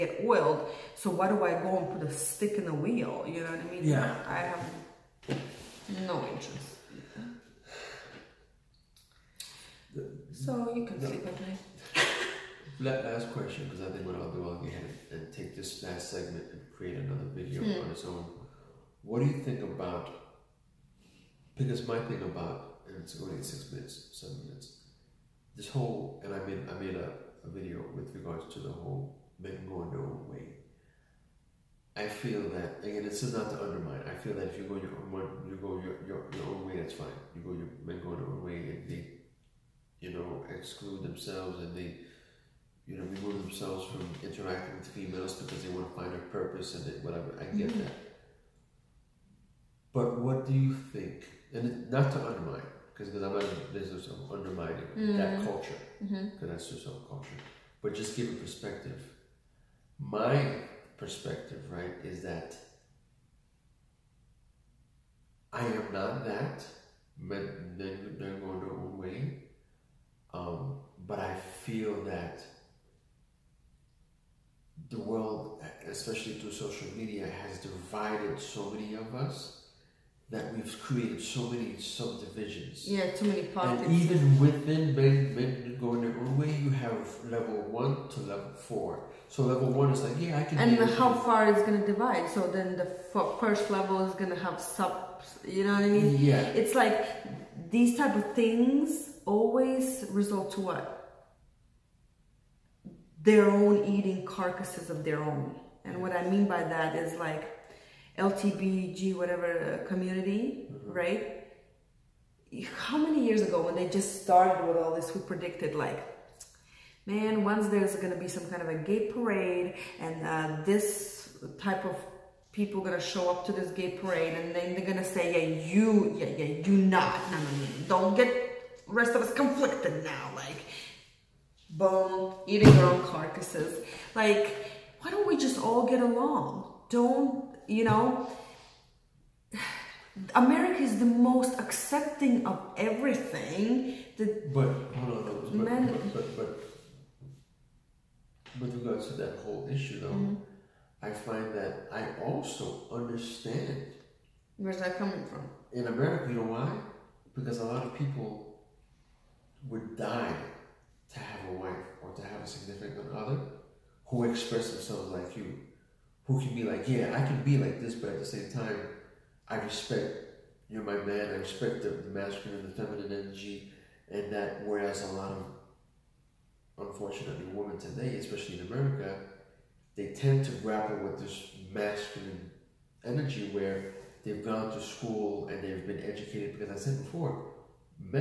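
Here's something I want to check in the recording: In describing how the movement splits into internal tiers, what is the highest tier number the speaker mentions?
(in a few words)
Level 4.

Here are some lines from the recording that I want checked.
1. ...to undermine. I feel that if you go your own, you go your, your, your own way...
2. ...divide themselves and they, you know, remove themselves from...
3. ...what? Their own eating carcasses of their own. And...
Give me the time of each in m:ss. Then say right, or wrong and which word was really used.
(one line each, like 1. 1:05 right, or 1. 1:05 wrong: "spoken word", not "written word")
1. 0:33 right
2. 0:40 wrong: "exclude", not "divide"
3. 1:40 right.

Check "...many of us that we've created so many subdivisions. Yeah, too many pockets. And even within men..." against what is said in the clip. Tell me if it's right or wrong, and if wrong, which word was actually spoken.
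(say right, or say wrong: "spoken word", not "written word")
right.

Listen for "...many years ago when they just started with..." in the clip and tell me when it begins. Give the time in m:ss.
1:52.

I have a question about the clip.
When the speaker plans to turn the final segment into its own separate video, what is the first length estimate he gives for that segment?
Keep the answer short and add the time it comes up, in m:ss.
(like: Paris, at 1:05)
6 minutes, at 0:23.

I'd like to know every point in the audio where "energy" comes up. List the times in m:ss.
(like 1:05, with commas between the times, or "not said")
2:53, 3:03.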